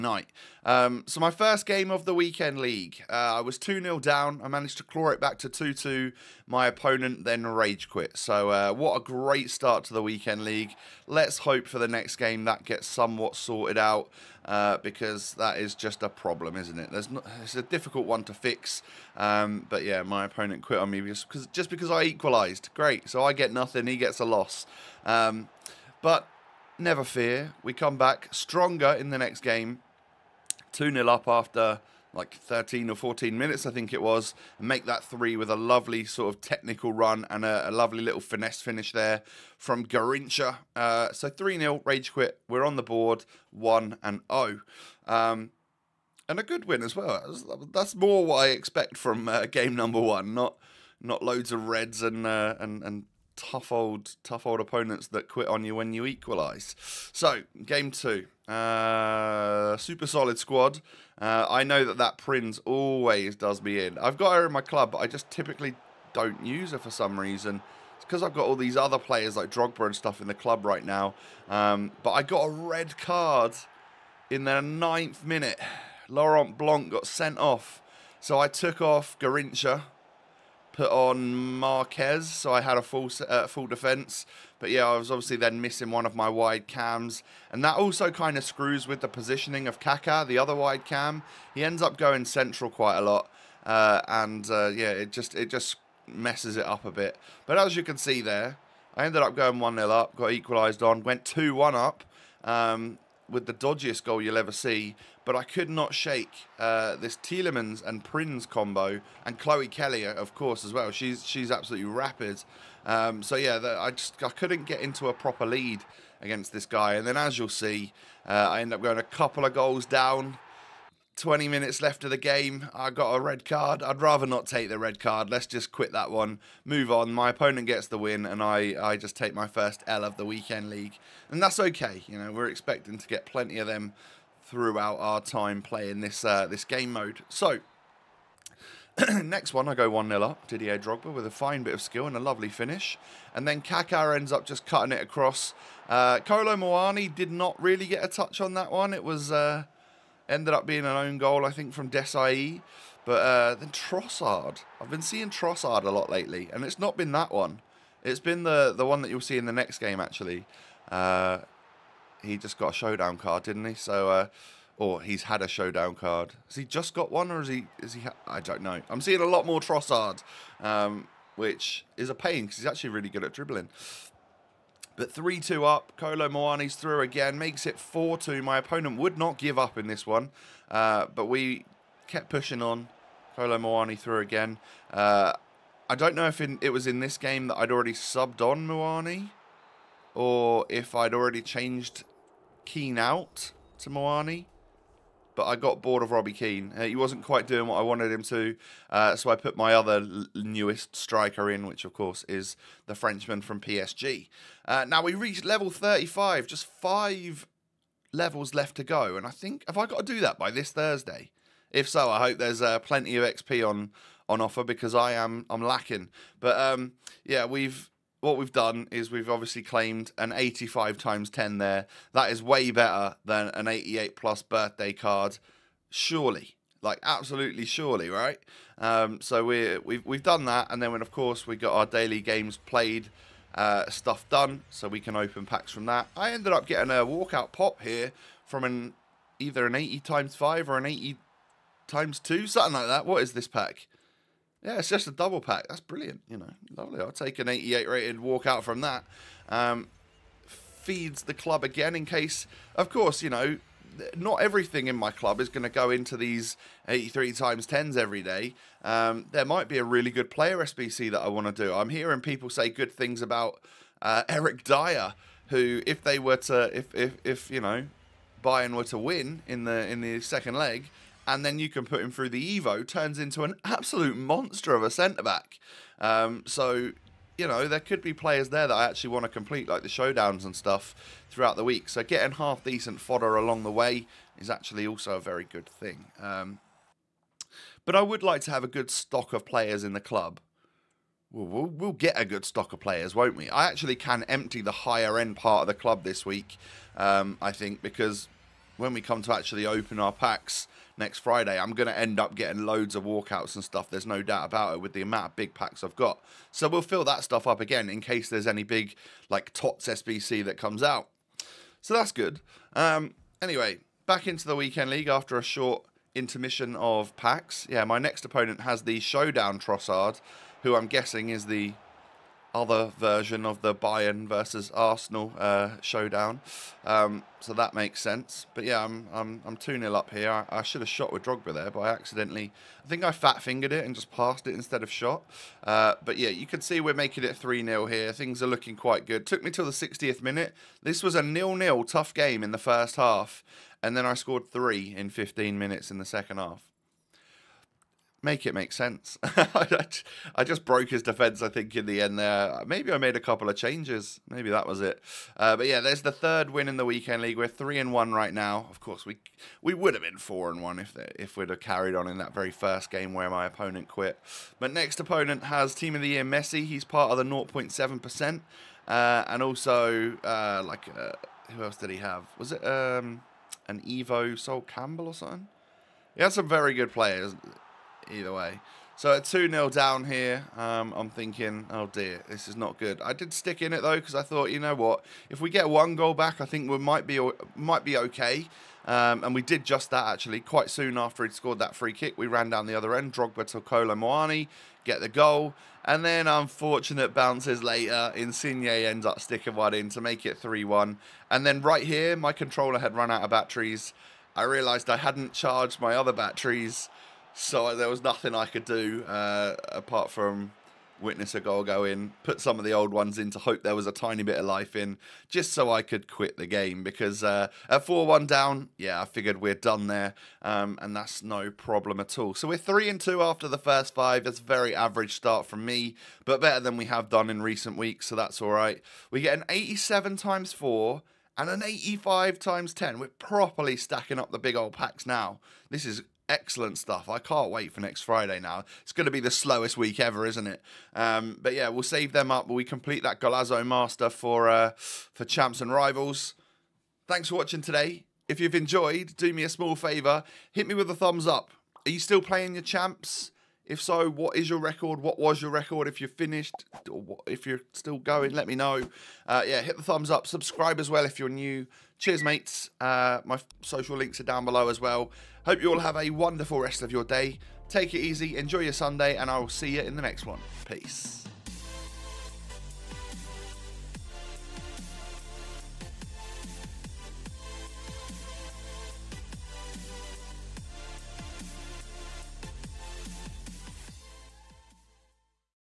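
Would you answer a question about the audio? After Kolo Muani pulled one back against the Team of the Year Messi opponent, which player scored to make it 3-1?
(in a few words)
Insigne.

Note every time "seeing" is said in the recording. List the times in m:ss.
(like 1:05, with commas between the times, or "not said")
2:35, 2:49.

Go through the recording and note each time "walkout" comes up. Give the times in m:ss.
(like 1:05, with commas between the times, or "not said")
3:57, 4:08, 5:03.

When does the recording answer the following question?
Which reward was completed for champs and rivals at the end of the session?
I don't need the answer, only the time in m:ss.
7:23.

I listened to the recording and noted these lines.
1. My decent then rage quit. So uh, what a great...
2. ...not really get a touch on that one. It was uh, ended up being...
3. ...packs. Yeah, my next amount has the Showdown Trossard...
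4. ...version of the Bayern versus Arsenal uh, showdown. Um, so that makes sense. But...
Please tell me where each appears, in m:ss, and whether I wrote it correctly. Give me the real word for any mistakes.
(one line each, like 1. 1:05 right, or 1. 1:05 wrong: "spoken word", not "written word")
1. 0:06 wrong: "opponent", not "decent"
2. 2:27 right
3. 5:17 wrong: "opponent", not "amount"
4. 5:22 right.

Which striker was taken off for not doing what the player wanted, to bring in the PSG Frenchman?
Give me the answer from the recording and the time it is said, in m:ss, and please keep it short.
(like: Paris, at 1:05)
Robbie Keane, at 3:16.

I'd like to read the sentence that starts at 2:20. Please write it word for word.
Didier Drogba with a fine bit of skill and a lovely finish.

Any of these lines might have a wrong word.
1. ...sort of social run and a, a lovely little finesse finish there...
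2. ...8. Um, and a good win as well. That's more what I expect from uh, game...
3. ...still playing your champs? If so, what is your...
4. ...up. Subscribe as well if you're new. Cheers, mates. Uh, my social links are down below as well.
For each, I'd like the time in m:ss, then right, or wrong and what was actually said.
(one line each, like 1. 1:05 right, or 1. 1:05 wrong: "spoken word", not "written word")
1. 0:36 wrong: "technical", not "social"
2. 0:44 wrong: "0", not "8"
3. 7:32 right
4. 7:40 right.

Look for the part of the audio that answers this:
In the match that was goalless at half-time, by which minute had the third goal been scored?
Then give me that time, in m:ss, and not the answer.
5:39.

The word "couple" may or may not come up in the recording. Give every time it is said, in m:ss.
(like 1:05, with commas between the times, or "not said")
1:59, 5:53.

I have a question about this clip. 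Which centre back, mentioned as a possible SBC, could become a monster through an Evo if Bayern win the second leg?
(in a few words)
Eric Dier.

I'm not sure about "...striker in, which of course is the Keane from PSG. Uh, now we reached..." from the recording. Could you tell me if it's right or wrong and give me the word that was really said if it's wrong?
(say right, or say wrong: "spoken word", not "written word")
wrong: "Frenchman", not "Keane".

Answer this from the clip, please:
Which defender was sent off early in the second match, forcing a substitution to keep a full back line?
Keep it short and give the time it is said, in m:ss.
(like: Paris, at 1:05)
Laurent Blanc, at 1:16.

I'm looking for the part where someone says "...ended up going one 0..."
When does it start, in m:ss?
1:39.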